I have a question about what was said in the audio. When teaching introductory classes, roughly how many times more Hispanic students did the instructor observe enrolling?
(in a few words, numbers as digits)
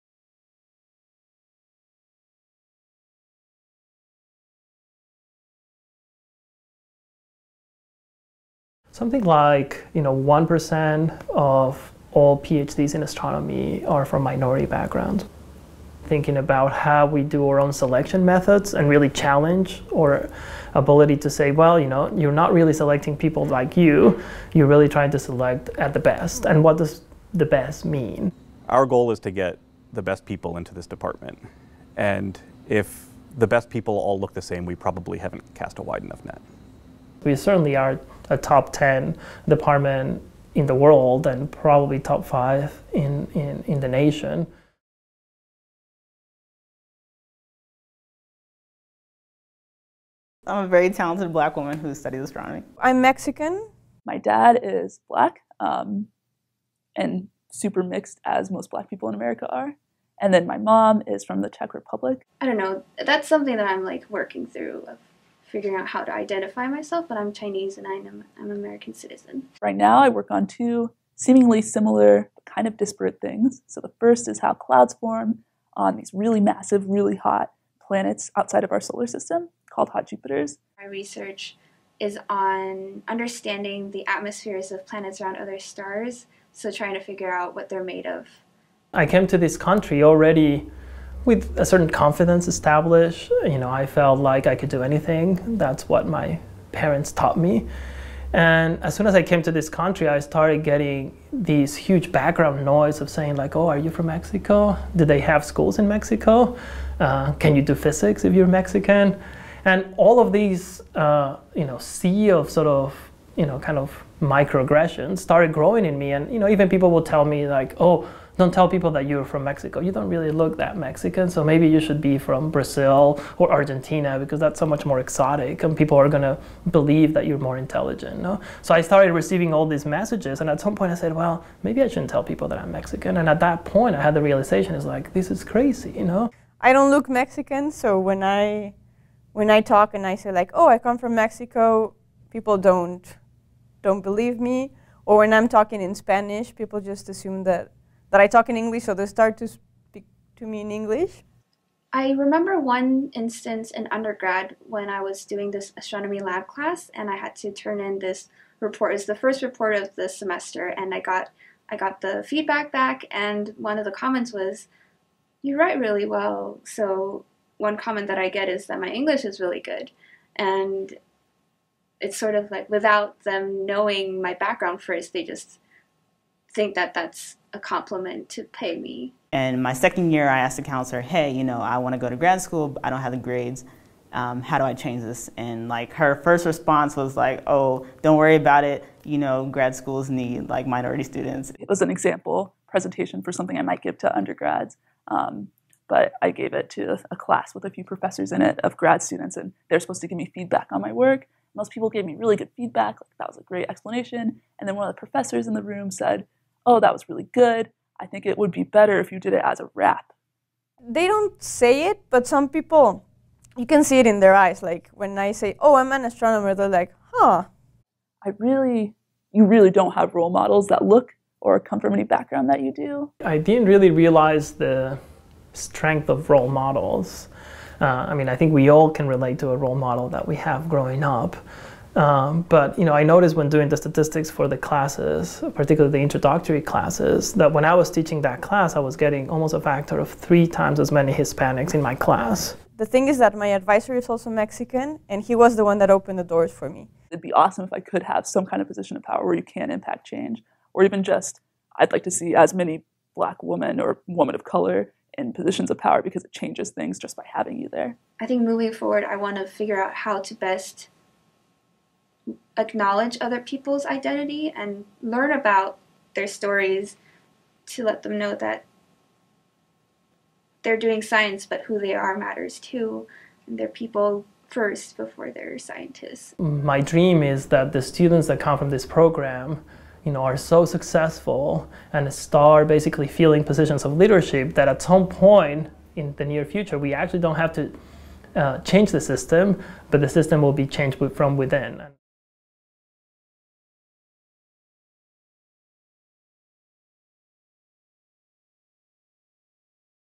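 3.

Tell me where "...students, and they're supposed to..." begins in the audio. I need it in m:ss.
3:19.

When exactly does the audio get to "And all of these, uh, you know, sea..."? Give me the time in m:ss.
1:49.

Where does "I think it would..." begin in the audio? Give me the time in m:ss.
3:27.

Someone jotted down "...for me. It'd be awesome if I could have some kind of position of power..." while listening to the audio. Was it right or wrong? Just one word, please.
right.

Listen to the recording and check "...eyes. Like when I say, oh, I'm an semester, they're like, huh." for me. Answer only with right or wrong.
wrong.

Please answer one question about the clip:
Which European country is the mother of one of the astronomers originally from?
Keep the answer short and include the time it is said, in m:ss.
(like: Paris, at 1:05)
Czech Republic, at 1:01.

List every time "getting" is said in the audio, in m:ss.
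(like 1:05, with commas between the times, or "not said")
1:40, 3:58.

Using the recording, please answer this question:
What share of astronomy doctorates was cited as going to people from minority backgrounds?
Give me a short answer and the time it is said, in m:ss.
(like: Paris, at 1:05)
1%, at 0:10.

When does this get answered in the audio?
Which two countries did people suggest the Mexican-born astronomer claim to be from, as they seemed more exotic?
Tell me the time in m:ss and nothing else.
2:02.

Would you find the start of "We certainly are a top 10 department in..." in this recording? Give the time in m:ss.
0:37.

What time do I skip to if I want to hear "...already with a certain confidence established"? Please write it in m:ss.
1:30.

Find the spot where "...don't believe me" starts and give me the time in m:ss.
2:23.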